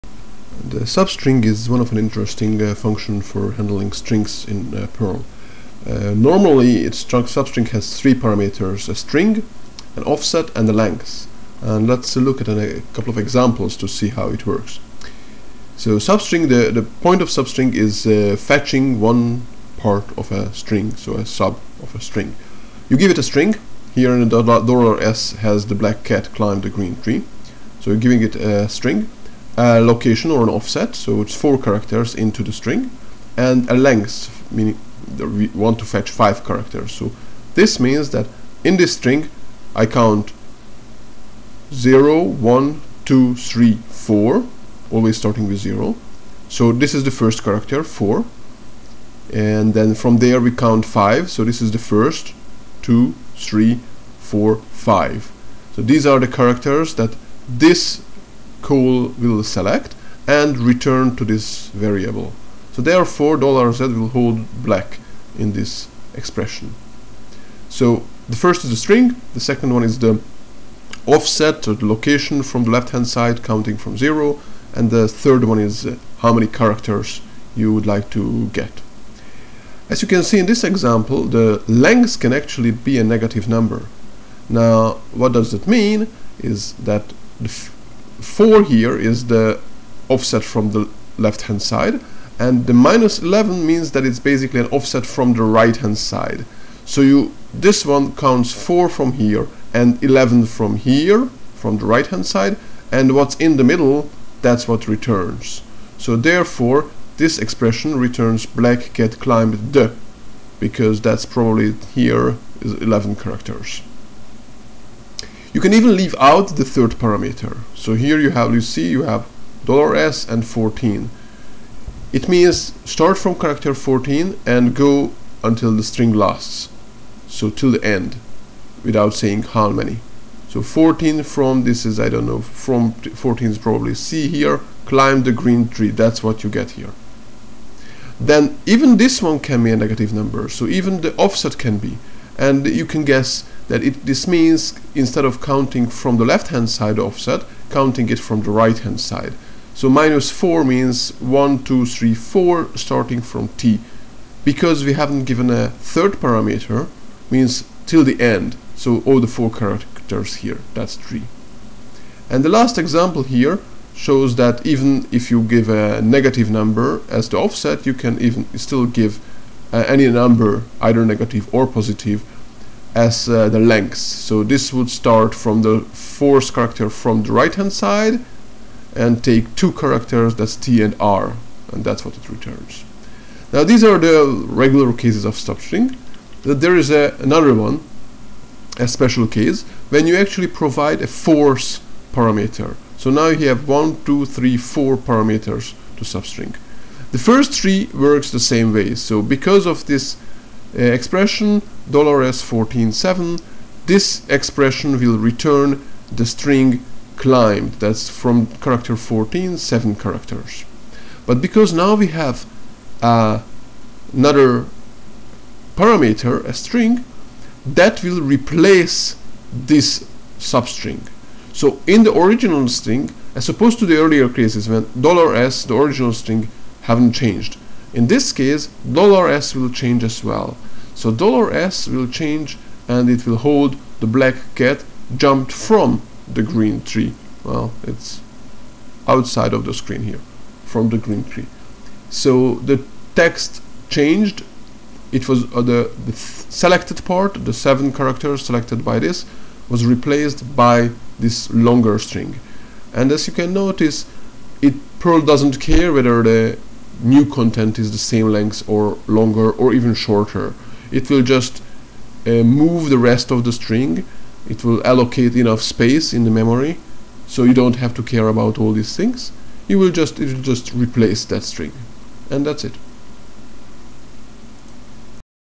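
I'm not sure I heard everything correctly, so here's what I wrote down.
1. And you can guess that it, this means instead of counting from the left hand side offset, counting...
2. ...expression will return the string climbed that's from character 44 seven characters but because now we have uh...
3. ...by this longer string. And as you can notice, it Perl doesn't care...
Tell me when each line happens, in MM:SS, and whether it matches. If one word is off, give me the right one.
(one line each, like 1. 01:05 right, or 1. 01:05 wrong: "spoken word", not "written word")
1. 02:22 right
2. 03:24 wrong: "14", not "44"
3. 04:10 right.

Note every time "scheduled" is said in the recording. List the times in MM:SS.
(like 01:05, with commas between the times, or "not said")
not said.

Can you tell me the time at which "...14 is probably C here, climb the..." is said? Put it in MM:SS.
02:12.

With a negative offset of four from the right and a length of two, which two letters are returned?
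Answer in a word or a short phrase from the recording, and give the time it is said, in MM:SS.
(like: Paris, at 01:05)
T and R, at 03:00.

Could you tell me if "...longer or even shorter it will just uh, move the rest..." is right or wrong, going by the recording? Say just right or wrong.
right.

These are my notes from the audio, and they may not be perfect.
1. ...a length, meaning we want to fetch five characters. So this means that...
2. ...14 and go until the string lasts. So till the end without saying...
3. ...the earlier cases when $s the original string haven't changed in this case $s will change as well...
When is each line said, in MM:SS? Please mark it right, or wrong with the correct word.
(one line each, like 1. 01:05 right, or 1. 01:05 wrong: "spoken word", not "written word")
1. 00:33 right
2. 02:03 right
3. 03:43 right.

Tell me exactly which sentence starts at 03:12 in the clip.
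So now you have one, two, three, four parameters to substring.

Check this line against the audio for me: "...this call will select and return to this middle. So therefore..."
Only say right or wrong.
wrong.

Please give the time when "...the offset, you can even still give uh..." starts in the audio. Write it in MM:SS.
02:47.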